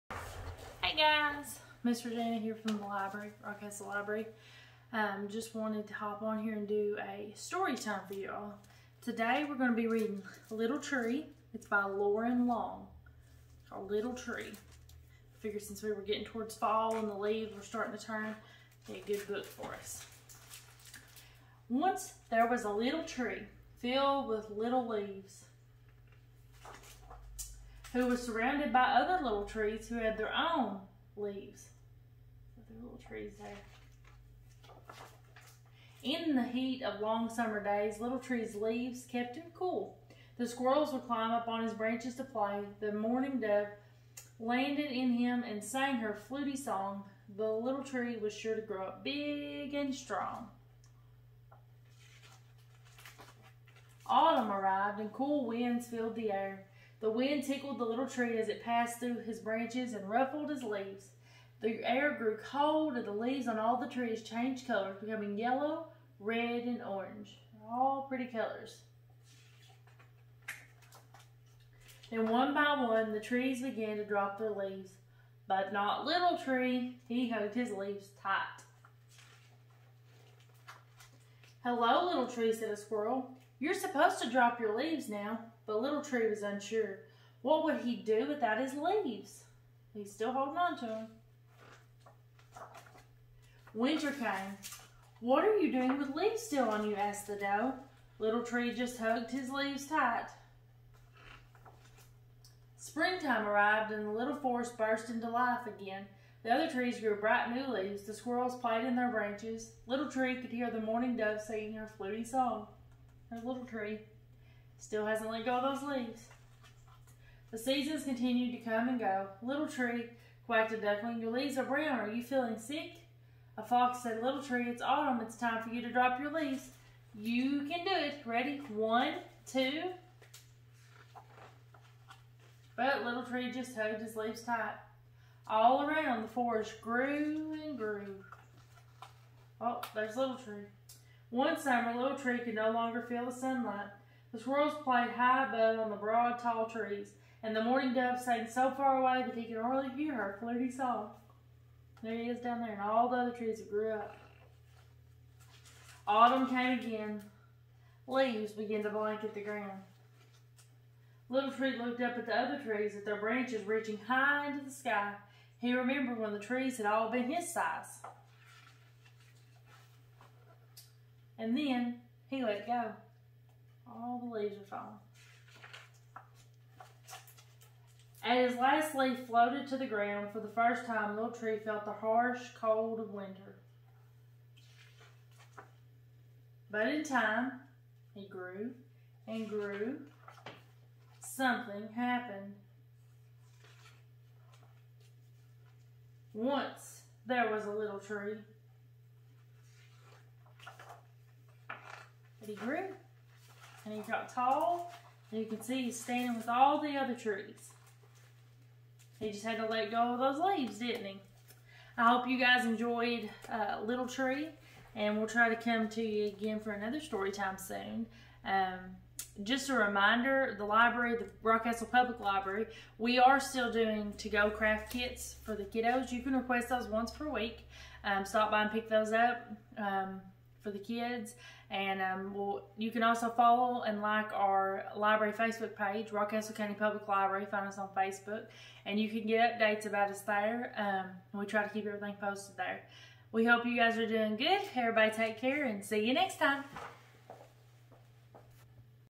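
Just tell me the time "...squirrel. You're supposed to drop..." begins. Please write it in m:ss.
1:22.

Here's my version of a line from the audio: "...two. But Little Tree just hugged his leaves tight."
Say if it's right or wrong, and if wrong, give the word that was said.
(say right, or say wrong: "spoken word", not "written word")
right.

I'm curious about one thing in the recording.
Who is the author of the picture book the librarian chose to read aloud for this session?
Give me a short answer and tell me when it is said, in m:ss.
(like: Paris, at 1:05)
Loren Long, at 0:11.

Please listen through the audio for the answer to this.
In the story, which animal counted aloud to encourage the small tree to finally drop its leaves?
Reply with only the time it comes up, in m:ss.
2:03.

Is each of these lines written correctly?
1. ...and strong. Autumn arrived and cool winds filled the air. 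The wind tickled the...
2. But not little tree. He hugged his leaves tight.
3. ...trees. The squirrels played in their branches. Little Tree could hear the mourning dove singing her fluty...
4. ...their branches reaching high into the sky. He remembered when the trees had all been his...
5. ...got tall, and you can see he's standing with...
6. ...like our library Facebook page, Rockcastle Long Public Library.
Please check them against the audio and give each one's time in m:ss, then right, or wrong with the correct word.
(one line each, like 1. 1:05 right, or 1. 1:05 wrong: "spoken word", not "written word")
1. 0:49 right
2. 1:15 right
3. 1:47 wrong: "leaves", not "trees"
4. 2:43 right
5. 3:24 right
6. 3:54 wrong: "County", not "Long".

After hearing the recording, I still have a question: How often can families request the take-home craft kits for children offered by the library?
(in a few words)
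once per week.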